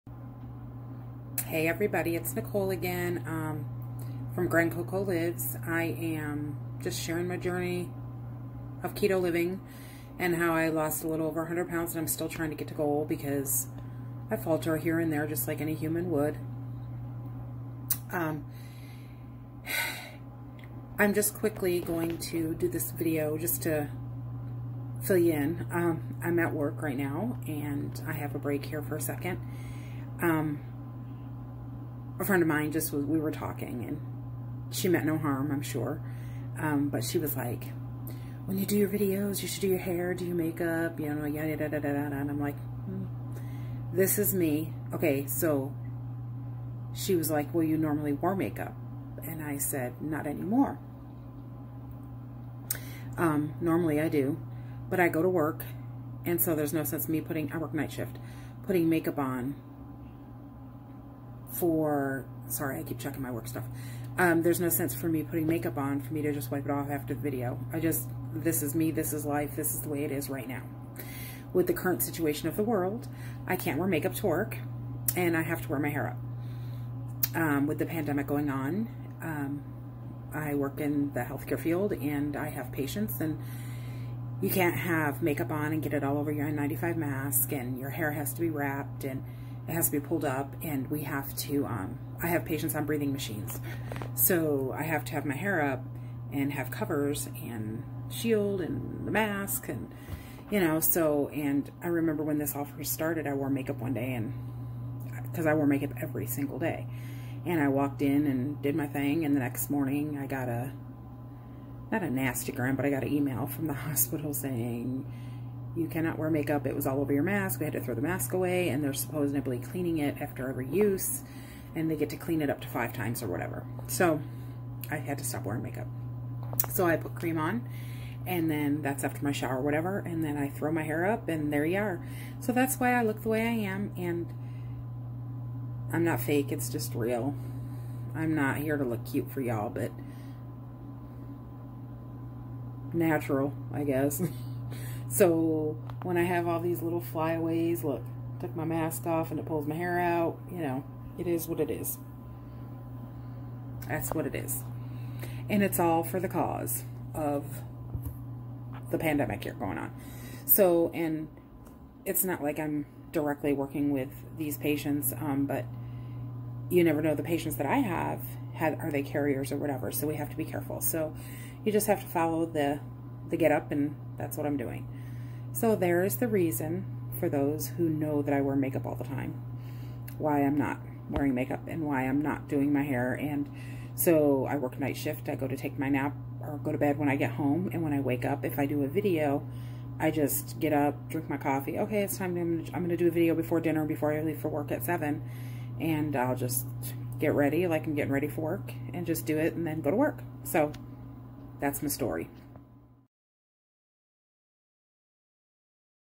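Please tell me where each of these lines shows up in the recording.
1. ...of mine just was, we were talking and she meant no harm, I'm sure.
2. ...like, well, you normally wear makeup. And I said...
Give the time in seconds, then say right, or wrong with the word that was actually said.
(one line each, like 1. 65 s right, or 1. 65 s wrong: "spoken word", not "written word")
1. 32 s right
2. 47 s right.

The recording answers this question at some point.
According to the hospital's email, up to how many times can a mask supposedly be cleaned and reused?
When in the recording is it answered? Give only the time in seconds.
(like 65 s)
122 s.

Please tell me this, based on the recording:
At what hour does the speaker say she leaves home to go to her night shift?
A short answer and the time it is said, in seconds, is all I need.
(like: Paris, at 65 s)
7, at 194 s.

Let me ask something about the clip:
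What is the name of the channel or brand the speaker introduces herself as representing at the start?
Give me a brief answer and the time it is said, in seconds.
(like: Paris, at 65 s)
Grand Coco Lives, at 4 s.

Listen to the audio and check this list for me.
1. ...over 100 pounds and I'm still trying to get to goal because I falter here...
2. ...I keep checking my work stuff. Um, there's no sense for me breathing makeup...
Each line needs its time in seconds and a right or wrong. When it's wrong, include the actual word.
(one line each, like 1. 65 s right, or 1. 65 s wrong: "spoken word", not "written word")
1. 11 s right
2. 62 s wrong: "putting", not "breathing".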